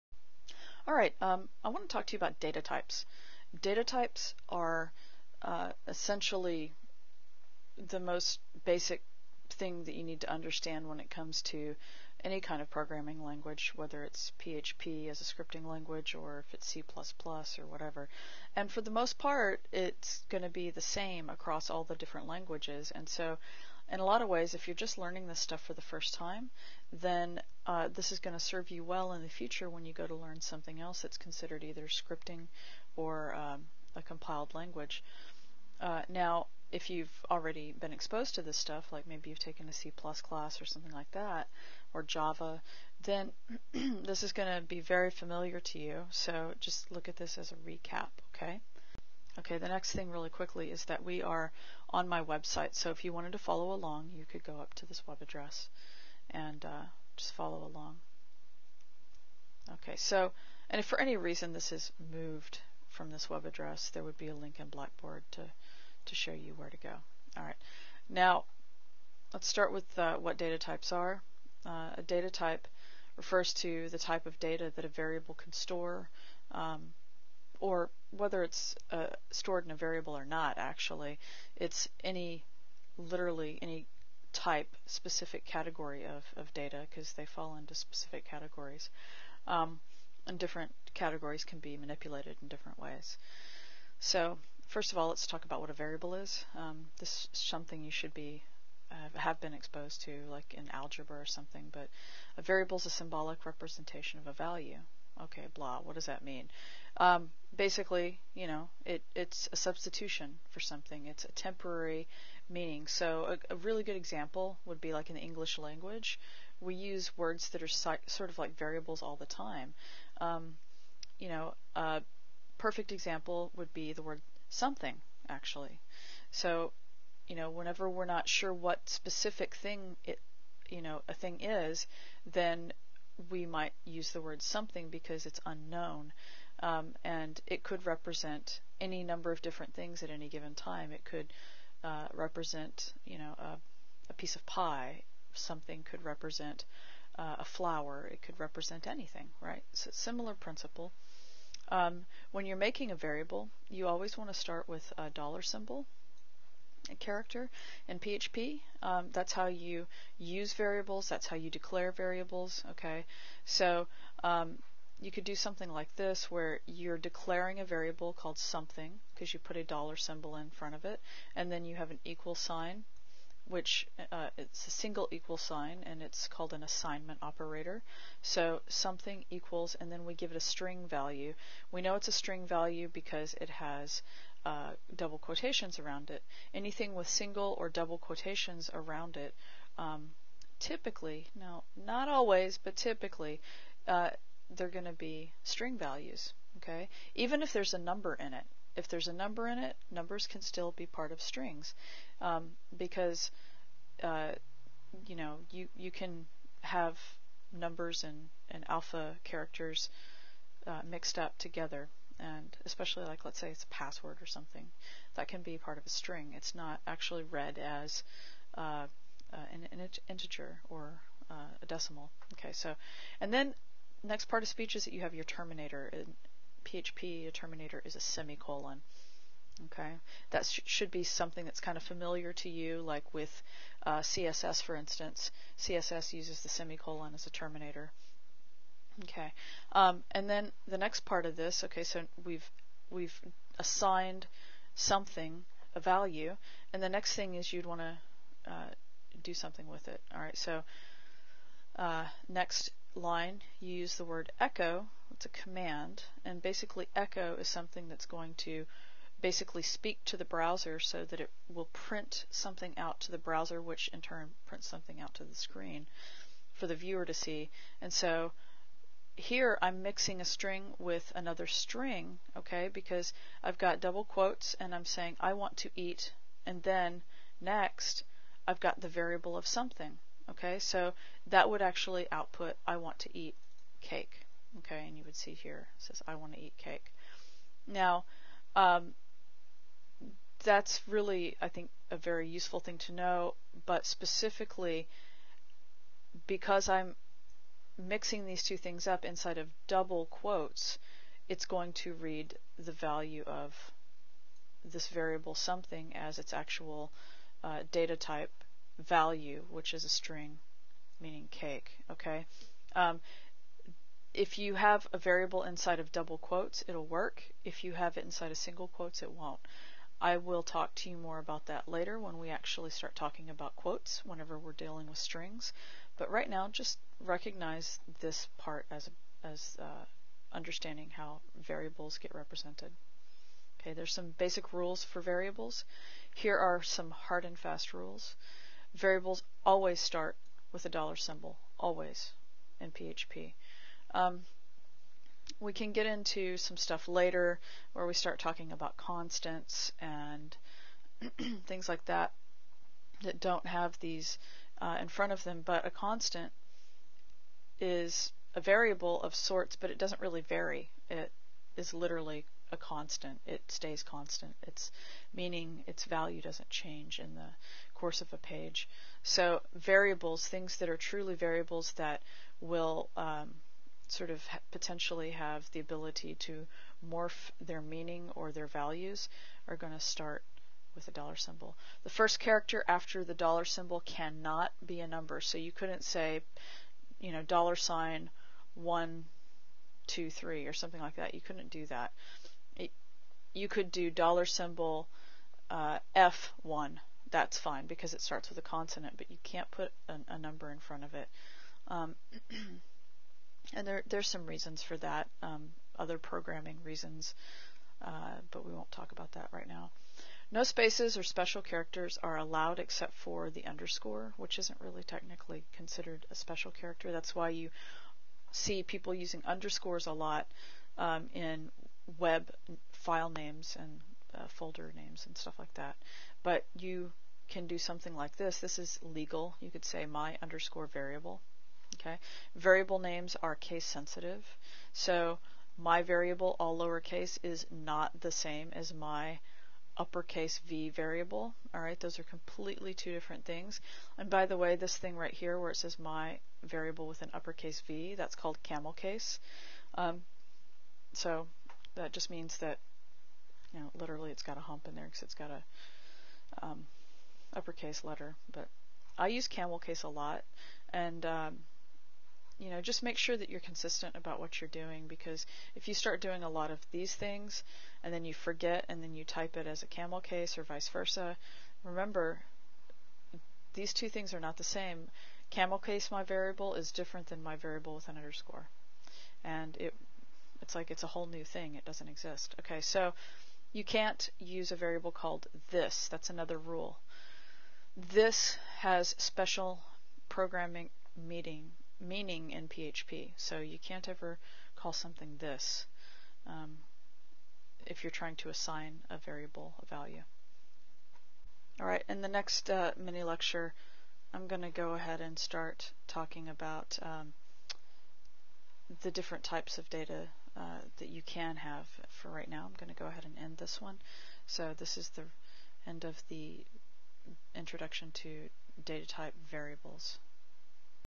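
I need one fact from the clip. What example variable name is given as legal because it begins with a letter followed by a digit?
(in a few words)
F1.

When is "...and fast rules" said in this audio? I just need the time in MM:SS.
05:37.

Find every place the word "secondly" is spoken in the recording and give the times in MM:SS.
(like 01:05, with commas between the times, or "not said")
not said.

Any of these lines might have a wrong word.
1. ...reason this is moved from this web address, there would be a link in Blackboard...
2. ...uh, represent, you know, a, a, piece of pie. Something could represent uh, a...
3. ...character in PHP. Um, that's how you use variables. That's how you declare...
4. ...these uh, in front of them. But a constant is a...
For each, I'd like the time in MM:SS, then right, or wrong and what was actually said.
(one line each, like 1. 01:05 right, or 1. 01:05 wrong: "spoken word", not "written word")
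1. 01:01 right
2. 02:21 right
3. 02:36 right
4. 05:53 right.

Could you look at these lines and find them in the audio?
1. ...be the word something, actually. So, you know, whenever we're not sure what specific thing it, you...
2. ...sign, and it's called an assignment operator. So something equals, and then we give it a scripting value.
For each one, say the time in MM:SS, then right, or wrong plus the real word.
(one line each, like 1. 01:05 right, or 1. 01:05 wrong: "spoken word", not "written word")
1. 02:03 right
2. 02:55 wrong: "string", not "scripting".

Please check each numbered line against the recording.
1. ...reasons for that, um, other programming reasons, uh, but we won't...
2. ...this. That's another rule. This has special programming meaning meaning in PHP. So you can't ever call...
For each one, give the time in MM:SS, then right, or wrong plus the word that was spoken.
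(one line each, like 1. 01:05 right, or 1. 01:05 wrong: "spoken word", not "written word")
1. 06:44 right
2. 08:05 right.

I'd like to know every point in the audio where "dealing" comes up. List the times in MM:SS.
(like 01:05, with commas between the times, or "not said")
05:24.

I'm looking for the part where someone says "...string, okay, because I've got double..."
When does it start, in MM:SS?
04:31.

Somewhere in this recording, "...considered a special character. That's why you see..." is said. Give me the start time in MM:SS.
06:55.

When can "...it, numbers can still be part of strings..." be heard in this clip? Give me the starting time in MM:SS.
03:19.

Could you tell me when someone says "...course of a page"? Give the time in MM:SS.
06:07.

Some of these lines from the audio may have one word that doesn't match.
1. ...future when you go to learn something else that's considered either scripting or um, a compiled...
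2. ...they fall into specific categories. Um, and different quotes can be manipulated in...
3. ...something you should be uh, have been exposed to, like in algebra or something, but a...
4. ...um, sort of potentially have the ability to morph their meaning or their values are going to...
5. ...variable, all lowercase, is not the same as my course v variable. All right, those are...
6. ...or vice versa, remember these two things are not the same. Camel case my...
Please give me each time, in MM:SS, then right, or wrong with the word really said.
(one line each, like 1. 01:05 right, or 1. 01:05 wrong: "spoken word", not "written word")
1. 00:29 right
2. 01:27 wrong: "categories", not "quotes"
3. 01:37 right
4. 06:12 right
5. 07:15 wrong: "uppercase", not "course"
6. 07:50 right.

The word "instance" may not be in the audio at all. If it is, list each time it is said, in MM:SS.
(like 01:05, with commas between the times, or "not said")
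03:54.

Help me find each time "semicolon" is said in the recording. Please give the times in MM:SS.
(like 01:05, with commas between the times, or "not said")
03:47, 03:56.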